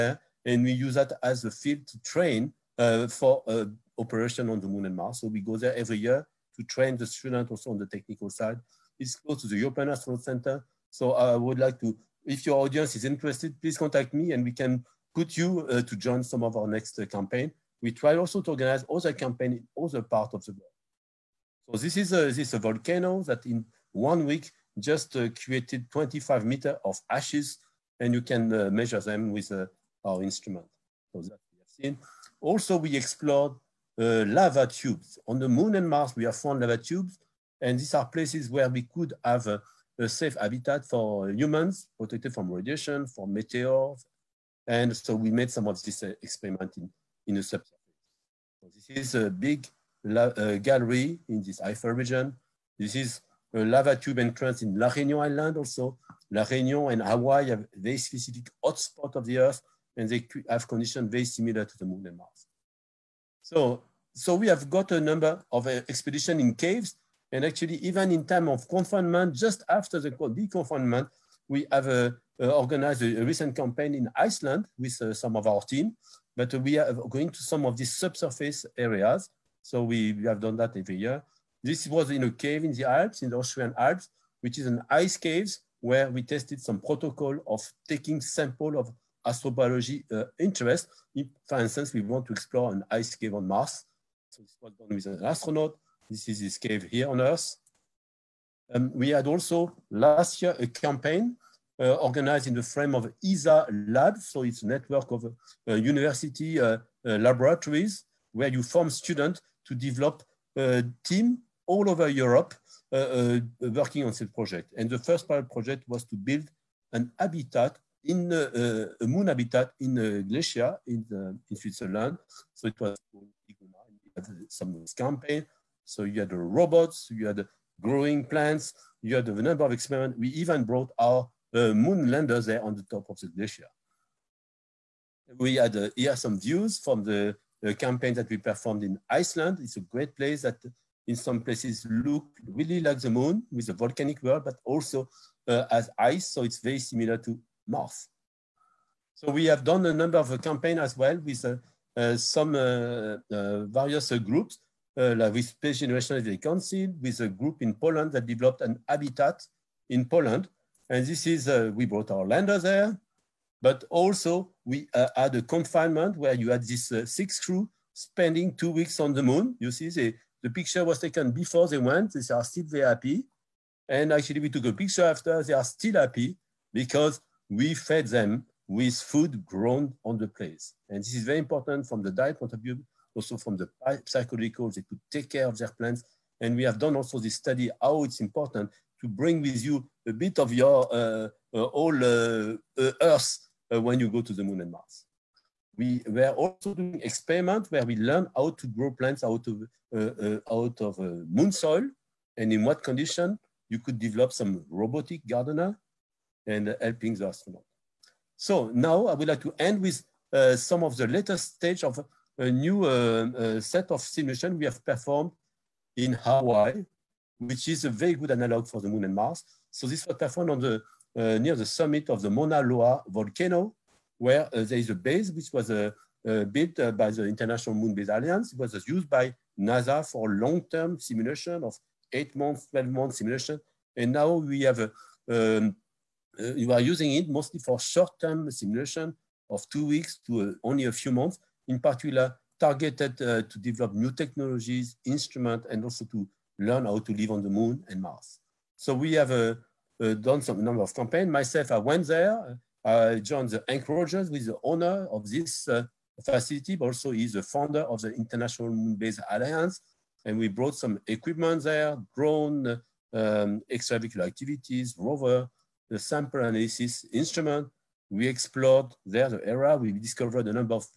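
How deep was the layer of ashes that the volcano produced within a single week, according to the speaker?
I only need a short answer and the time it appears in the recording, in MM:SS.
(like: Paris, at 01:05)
25 meters, at 00:25.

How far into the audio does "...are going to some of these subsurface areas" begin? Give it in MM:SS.
01:16.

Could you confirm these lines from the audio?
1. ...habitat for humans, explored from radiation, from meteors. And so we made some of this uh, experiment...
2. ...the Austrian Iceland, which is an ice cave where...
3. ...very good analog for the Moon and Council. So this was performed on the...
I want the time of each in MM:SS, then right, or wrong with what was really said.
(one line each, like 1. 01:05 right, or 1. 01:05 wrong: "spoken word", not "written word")
1. 00:40 wrong: "protected", not "explored"
2. 01:23 wrong: "Alps", not "Iceland"
3. 03:37 wrong: "Mars", not "Council".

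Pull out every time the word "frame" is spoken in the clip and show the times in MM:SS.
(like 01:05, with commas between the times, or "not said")
01:42.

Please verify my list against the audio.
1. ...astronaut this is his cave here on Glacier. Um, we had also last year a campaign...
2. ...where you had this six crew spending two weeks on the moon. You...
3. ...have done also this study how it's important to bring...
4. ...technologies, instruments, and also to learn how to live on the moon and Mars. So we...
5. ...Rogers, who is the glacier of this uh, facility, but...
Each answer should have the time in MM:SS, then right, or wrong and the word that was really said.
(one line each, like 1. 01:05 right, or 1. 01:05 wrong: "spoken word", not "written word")
1. 01:35 wrong: "Earth", not "Glacier"
2. 02:46 right
3. 03:06 right
4. 04:04 right
5. 04:13 wrong: "owner", not "glacier".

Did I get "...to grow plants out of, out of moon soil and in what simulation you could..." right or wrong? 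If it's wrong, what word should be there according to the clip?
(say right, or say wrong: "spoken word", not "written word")
wrong: "condition", not "simulation".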